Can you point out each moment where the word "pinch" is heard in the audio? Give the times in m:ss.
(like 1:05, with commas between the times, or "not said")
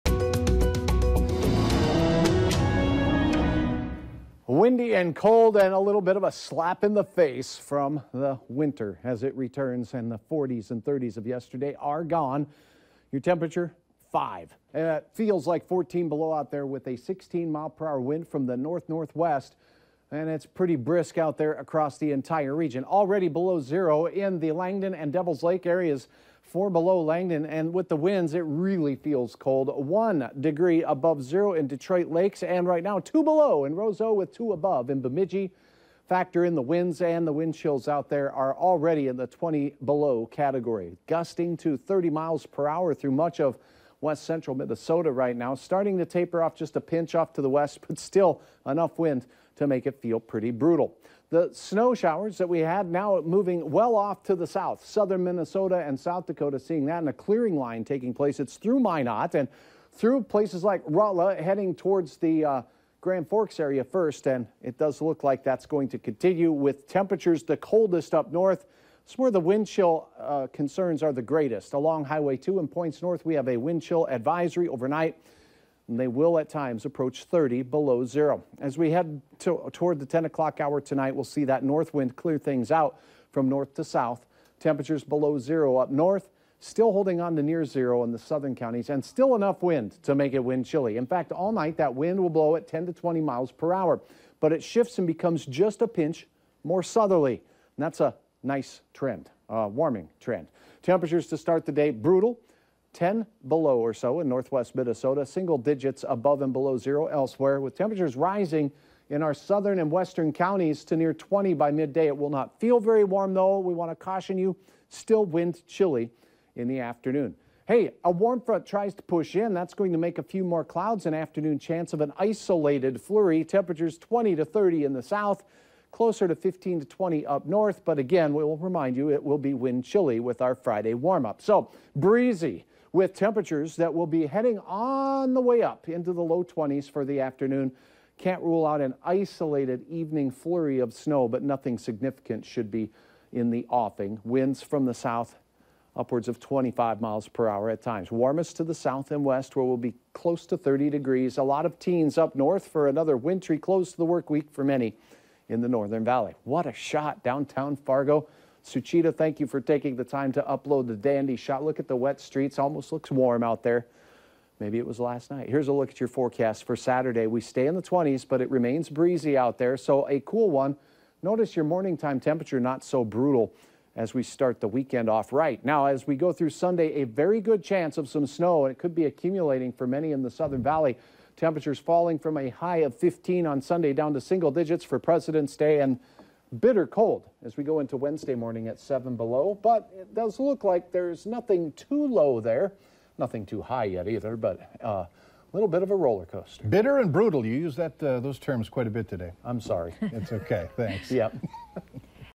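0:46, 1:35.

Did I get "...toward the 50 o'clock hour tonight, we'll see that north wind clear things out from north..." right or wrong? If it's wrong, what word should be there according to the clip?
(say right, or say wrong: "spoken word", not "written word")
wrong: "10", not "50".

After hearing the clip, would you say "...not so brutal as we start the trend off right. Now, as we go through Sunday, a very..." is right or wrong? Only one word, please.
wrong.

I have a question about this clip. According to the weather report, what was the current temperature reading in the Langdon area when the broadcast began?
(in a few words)
4 below.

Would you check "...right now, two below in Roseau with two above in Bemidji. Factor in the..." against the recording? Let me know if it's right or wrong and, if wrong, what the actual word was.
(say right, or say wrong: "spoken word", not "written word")
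right.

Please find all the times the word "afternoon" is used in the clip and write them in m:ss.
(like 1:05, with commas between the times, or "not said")
1:56, 2:01, 2:17.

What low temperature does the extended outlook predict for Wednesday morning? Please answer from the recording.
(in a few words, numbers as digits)
7 below.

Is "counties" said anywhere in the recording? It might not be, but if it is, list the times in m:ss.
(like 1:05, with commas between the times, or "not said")
1:28, 1:50.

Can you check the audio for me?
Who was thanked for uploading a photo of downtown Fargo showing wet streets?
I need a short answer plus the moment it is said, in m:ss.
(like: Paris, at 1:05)
Suchita, at 2:38.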